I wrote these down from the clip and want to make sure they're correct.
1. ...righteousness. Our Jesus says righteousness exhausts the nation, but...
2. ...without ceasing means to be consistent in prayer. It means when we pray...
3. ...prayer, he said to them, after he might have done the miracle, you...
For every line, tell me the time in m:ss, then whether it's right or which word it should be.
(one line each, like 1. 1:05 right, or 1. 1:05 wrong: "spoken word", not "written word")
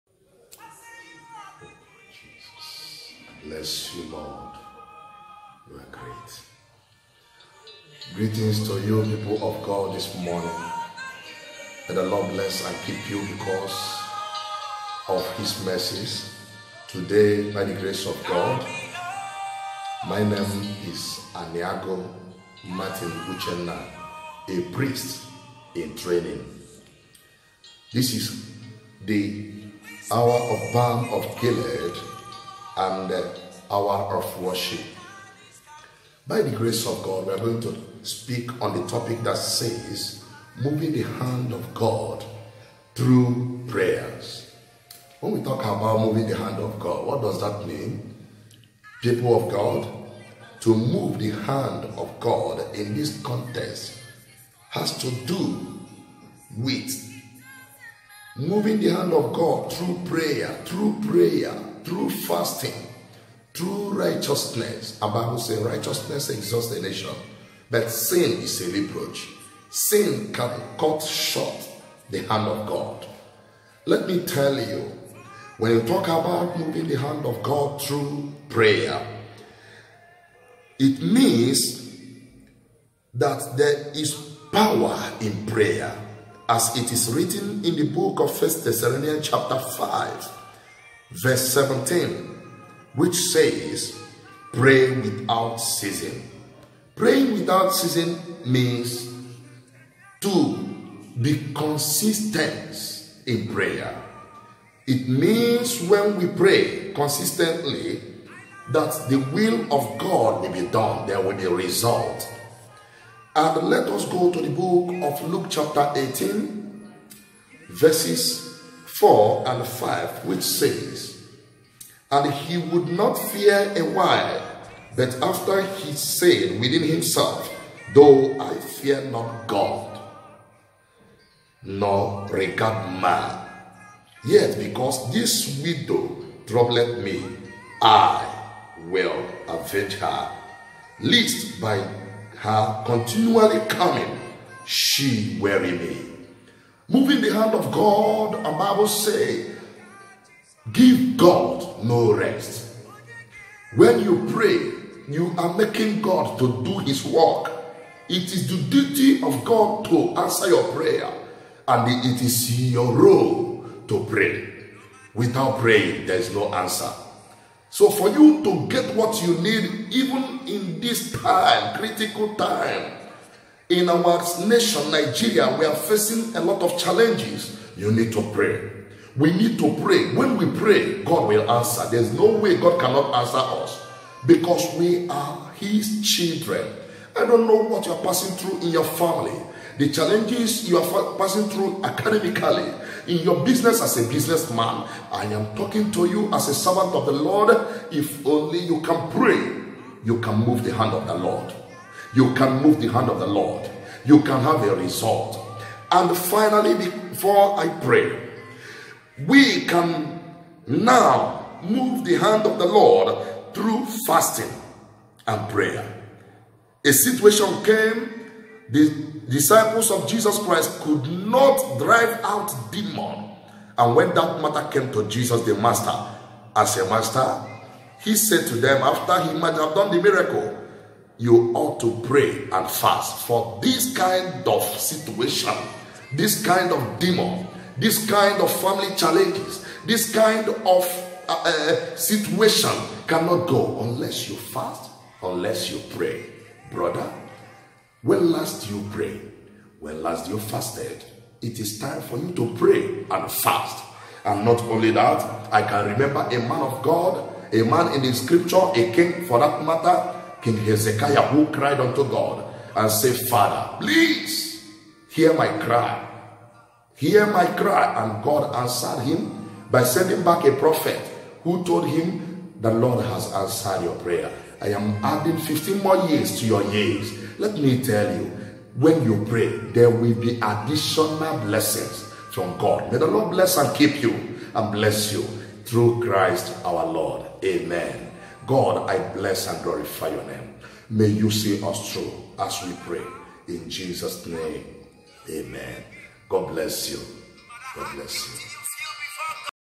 1. 1:03 wrong: "Bible", not "Jesus"
2. 1:37 right
3. 3:46 wrong: "master", not "prayer".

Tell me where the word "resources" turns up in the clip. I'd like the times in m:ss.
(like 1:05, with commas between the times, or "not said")
not said.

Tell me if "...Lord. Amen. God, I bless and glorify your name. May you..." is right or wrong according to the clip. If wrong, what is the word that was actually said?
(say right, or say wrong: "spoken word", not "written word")
right.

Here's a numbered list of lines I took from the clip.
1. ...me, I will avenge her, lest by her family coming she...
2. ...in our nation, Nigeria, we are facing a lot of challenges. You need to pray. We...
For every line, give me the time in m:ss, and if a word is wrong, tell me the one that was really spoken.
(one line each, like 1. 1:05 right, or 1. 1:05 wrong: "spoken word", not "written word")
1. 2:16 wrong: "continually", not "family"
2. 2:53 right.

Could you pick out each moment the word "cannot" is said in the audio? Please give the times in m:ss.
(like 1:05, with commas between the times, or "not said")
3:02, 4:03.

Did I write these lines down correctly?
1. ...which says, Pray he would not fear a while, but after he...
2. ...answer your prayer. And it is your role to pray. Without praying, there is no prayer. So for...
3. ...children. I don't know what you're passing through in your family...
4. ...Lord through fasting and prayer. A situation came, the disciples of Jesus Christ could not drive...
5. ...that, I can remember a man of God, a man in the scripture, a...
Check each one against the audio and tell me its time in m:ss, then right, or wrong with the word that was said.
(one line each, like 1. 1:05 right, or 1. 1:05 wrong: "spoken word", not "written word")
1. 2:00 wrong: "And", not "Pray"
2. 2:40 wrong: "answer", not "prayer"
3. 3:06 right
4. 3:32 right
5. 4:14 right.